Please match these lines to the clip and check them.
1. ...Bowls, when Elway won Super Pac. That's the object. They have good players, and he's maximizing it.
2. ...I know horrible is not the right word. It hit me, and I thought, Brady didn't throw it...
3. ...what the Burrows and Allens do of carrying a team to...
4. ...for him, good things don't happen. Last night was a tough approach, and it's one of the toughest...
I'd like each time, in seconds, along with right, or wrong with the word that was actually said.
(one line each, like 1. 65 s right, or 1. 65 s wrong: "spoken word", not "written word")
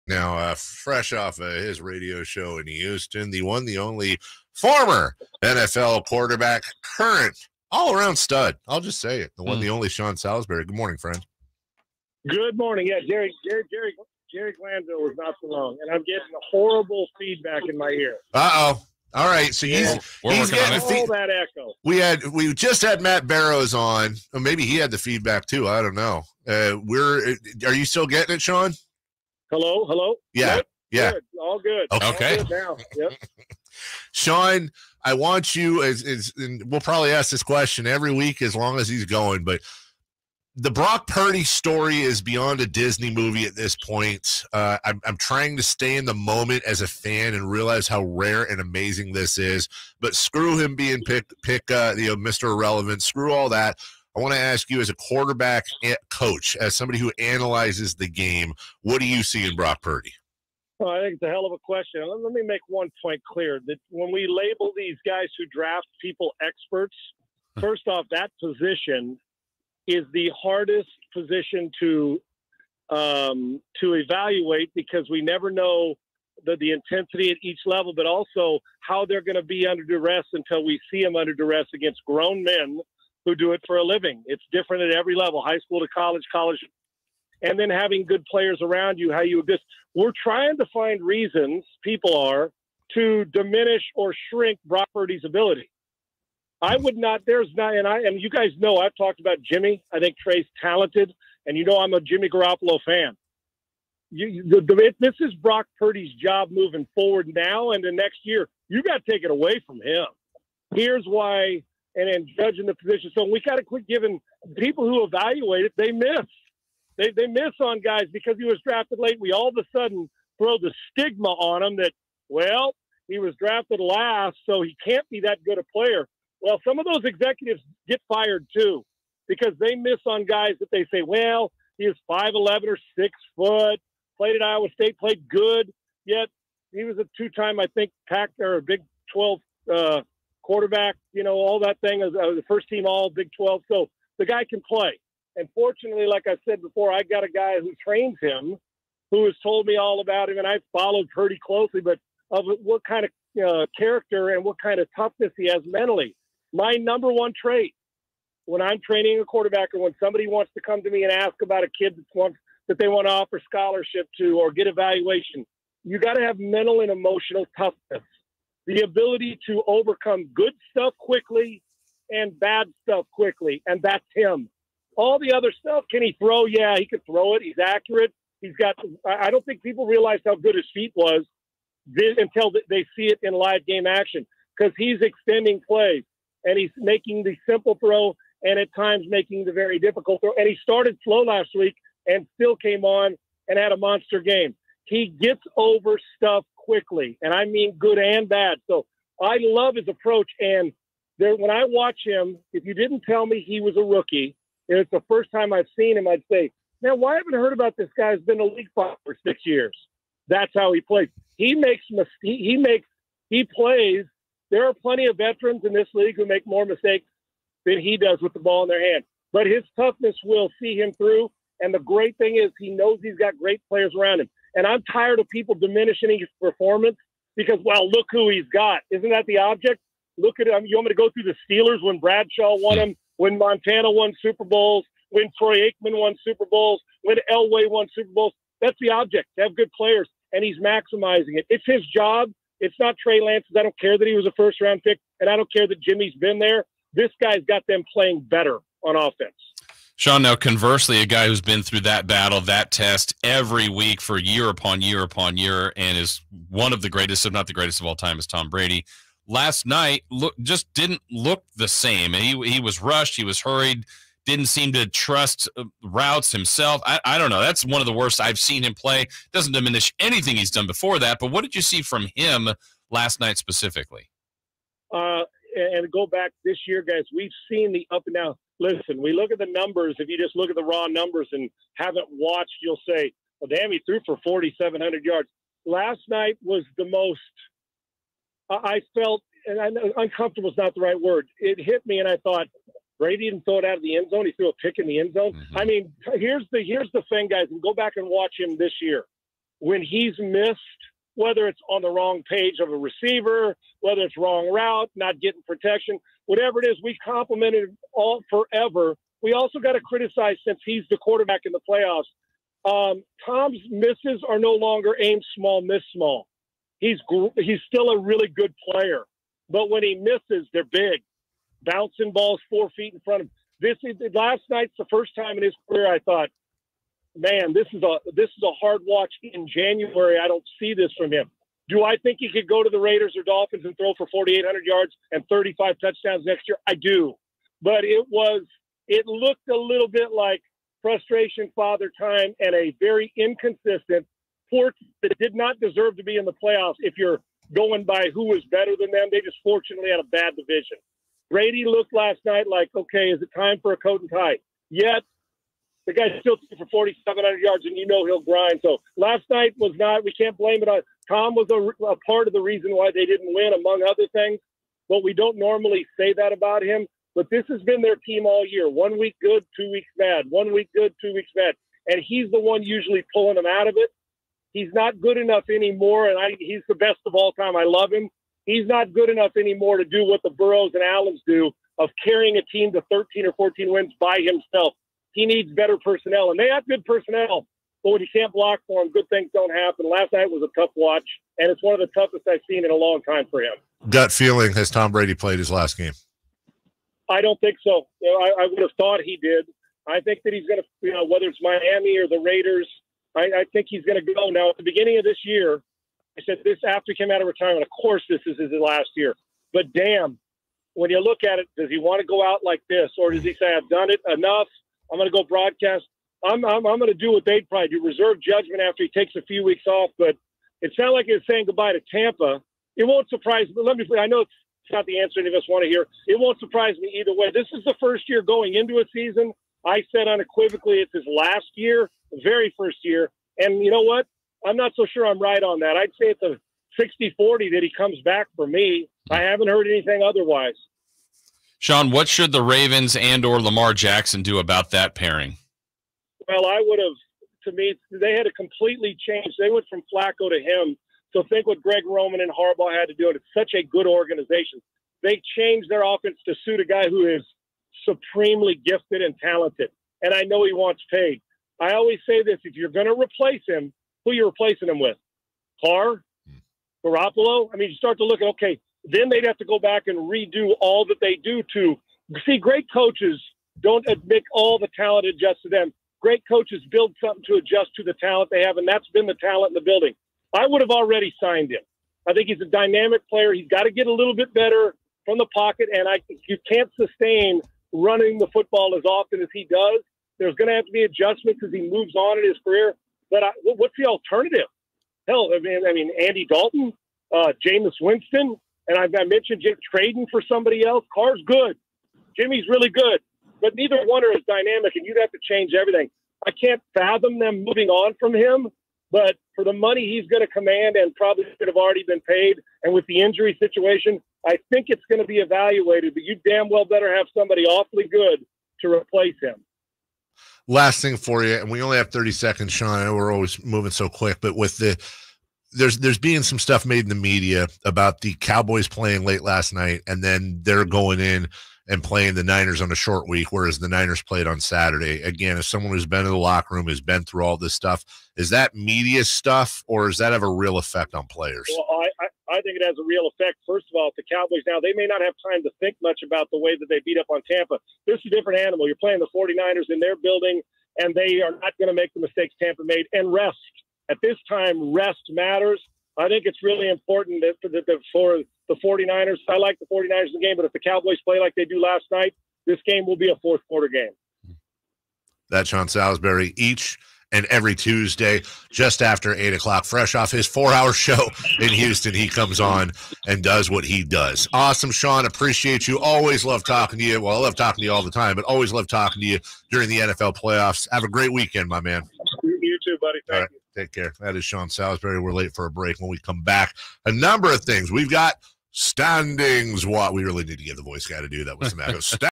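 1. 236 s wrong: "Bowls", not "Pac"
2. 289 s wrong: "uncomfortable", not "horrible"
3. 380 s right
4. 388 s wrong: "watch", not "approach".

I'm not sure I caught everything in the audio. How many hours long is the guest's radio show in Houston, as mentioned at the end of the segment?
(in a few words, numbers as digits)
4.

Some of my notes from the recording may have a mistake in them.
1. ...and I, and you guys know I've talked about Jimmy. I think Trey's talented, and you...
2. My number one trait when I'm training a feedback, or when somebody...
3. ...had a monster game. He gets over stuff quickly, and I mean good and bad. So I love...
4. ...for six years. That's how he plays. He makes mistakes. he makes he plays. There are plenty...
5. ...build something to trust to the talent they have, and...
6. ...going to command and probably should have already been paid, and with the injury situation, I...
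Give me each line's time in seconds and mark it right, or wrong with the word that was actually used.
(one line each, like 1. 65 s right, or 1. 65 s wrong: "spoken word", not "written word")
1. 97 s right
2. 156 s wrong: "quarterback", not "feedback"
3. 193 s right
4. 209 s right
5. 476 s wrong: "adjust", not "trust"
6. 510 s right.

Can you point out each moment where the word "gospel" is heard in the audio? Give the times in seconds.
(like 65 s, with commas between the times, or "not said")
not said.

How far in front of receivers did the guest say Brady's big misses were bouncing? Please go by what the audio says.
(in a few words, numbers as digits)
Four feet.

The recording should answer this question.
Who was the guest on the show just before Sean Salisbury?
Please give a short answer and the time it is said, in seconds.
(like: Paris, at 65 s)
Matt Barrows, at 23 s.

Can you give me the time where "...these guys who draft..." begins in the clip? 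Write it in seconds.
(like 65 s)
64 s.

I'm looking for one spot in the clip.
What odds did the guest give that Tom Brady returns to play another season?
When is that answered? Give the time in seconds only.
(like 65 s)
436 s.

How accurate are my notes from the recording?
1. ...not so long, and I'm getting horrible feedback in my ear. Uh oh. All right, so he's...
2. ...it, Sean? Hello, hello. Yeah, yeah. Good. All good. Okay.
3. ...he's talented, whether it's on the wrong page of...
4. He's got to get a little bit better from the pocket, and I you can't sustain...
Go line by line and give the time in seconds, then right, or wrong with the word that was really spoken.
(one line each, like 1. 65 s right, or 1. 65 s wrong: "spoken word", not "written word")
1. 15 s right
2. 28 s right
3. 299 s wrong: "missed", not "talented"
4. 483 s right.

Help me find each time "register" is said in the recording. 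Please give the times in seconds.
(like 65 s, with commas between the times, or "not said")
not said.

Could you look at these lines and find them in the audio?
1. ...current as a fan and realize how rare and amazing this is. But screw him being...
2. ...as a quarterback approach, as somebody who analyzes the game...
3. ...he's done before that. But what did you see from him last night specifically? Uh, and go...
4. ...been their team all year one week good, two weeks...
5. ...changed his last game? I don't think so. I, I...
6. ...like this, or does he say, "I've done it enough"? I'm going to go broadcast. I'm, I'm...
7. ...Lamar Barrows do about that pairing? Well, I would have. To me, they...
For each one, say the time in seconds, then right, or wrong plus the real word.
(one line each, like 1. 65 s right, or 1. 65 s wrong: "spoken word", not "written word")
1. 46 s wrong: "moment", not "current"
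2. 54 s wrong: "coach", not "approach"
3. 270 s right
4. 367 s right
5. 395 s wrong: "played", not "changed"
6. 412 s right
7. 443 s wrong: "Jackson", not "Barrows".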